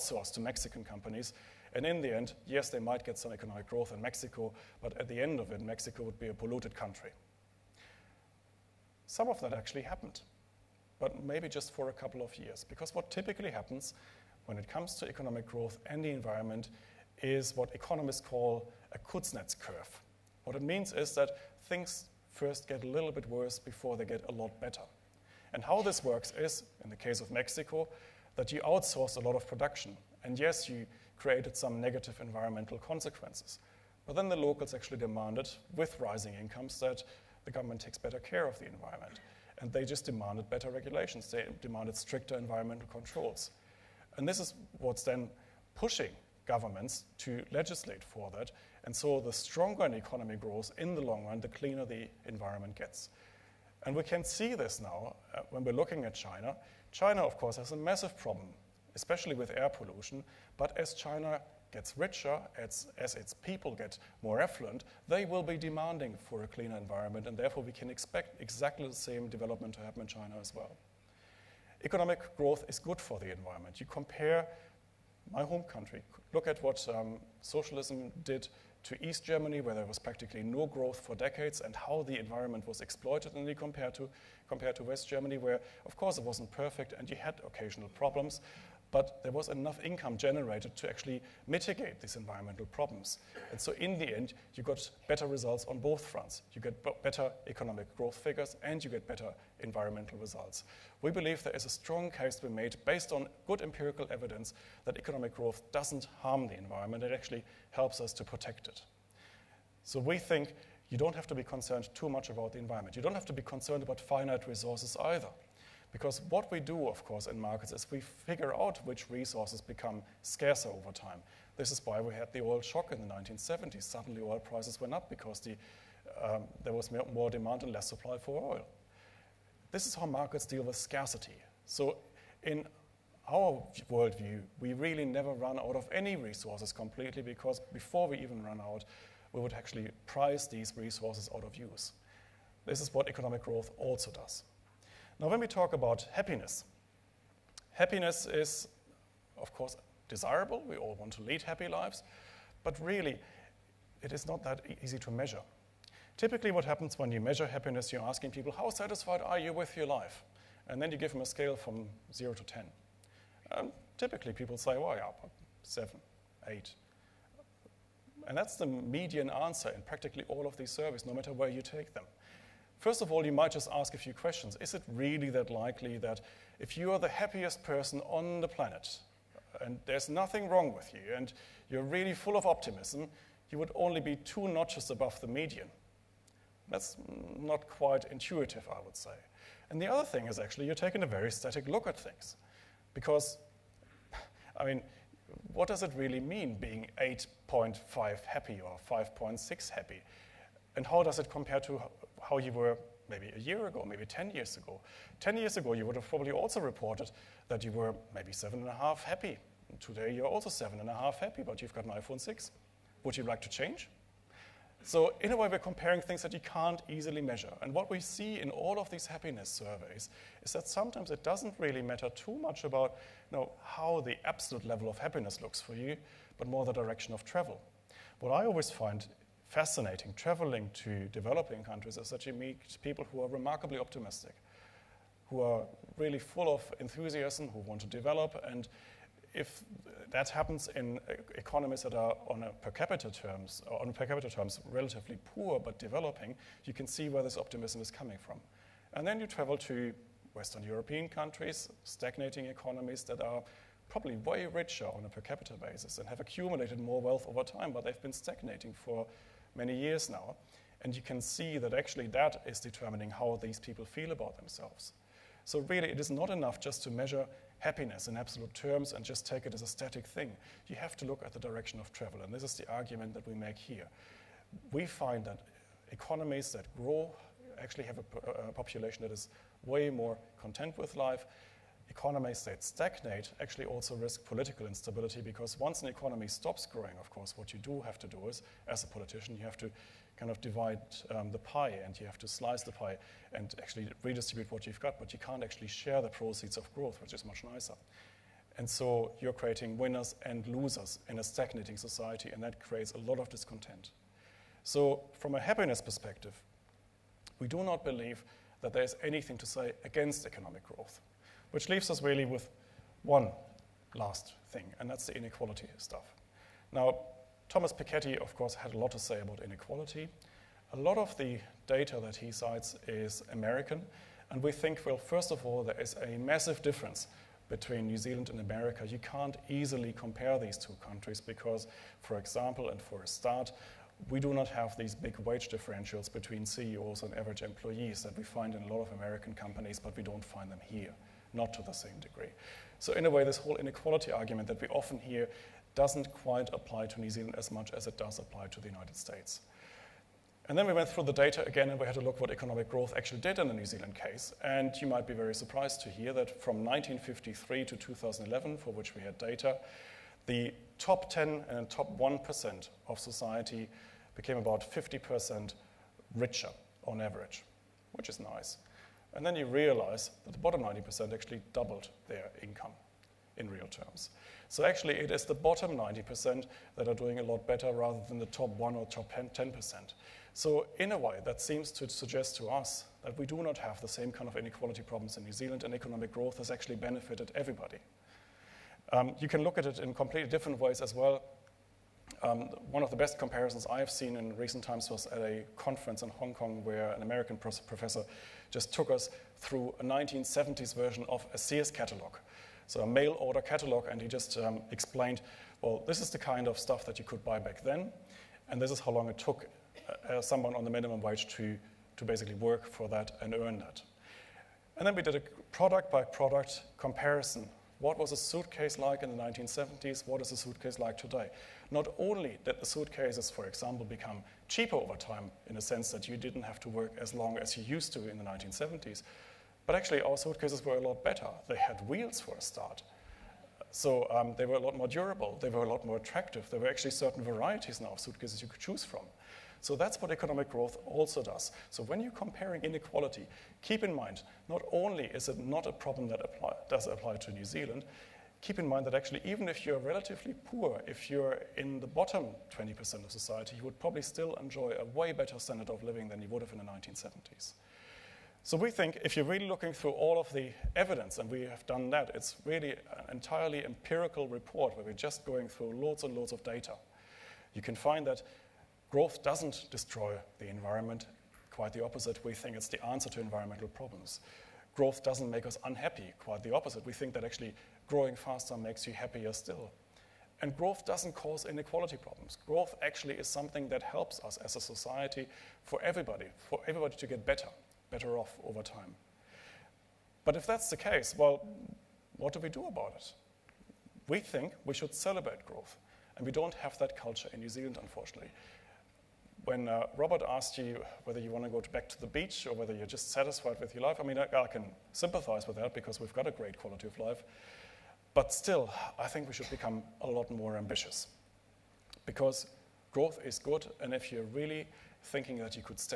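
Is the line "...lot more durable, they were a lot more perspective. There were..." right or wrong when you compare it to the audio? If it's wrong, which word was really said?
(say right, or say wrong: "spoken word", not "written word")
wrong: "attractive", not "perspective".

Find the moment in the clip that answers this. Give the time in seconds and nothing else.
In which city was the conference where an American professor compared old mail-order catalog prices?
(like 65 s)
396 s.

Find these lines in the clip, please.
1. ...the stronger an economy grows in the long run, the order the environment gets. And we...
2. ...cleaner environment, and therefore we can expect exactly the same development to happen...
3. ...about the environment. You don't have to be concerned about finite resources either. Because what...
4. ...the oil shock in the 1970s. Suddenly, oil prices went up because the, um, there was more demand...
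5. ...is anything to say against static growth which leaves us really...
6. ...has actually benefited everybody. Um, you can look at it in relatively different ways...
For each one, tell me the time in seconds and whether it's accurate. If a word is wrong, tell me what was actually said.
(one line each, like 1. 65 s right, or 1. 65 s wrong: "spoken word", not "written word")
1. 49 s wrong: "cleaner", not "order"
2. 66 s right
3. 112 s right
4. 122 s right
5. 308 s wrong: "economic", not "static"
6. 386 s wrong: "completely", not "relatively".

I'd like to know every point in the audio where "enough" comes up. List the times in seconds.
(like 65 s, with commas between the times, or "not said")
89 s, 266 s.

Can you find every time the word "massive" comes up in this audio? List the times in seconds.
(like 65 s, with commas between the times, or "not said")
57 s, 326 s.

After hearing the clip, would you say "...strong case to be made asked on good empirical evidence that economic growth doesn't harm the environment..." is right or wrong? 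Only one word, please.
wrong.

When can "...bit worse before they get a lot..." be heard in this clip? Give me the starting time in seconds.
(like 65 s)
23 s.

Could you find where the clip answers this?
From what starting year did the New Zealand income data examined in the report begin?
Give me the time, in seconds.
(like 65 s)
356 s.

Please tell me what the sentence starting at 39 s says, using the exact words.
And they just demanded better regulations.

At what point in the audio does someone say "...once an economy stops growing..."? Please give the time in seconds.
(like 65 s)
285 s.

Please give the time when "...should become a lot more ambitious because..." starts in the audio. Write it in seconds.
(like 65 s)
509 s.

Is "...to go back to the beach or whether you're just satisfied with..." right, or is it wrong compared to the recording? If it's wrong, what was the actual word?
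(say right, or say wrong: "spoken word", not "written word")
right.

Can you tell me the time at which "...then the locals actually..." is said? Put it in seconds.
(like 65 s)
34 s.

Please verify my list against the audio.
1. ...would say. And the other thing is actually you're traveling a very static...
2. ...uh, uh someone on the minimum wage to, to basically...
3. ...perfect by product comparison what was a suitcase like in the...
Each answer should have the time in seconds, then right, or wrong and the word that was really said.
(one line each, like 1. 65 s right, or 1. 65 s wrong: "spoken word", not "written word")
1. 188 s wrong: "taking", not "traveling"
2. 410 s right
3. 415 s wrong: "product", not "perfect".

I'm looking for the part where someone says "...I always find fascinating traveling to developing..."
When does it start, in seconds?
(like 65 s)
228 s.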